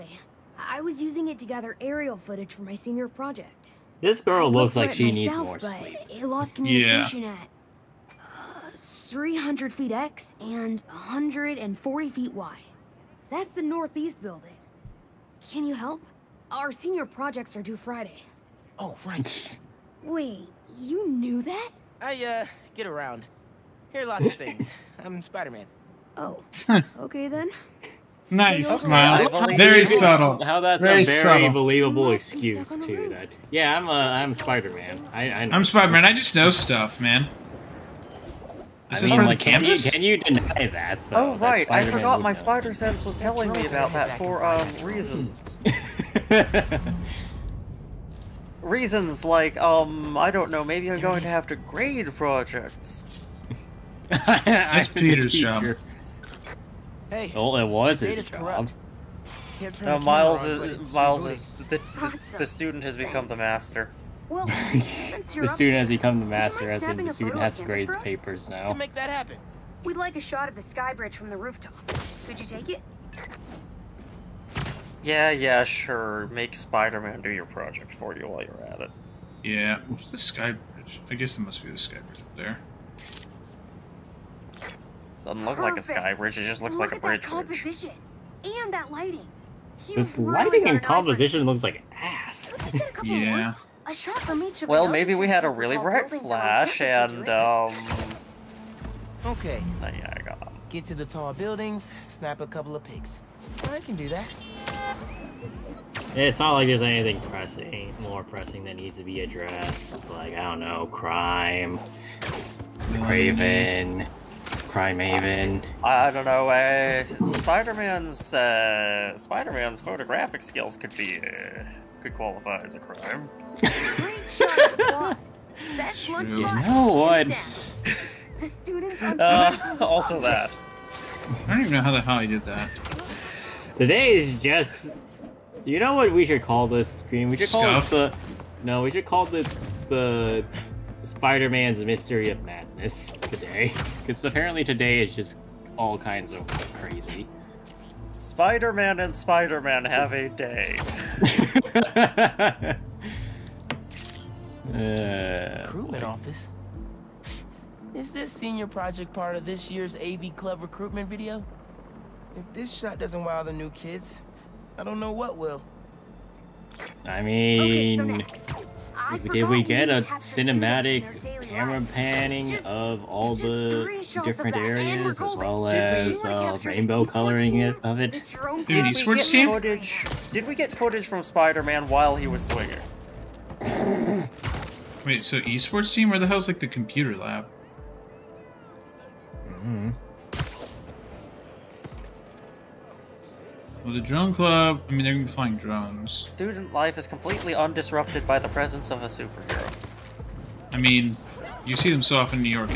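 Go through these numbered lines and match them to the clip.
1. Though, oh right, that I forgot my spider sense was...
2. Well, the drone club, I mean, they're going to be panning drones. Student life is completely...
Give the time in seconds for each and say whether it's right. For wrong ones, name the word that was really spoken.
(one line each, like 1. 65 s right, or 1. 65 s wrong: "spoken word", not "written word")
1. 41 s right
2. 193 s wrong: "flying", not "panning".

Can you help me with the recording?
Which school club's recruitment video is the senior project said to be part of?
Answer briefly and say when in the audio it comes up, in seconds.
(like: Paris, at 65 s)
AV Club, at 159 s.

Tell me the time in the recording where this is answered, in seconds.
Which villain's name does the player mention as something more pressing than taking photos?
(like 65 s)
112 s.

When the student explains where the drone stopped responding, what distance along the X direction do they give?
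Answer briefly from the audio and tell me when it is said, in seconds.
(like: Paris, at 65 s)
300 feet, at 8 s.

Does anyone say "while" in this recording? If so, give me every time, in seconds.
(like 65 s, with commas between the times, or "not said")
78 s, 181 s.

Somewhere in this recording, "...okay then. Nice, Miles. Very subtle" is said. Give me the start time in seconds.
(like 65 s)
27 s.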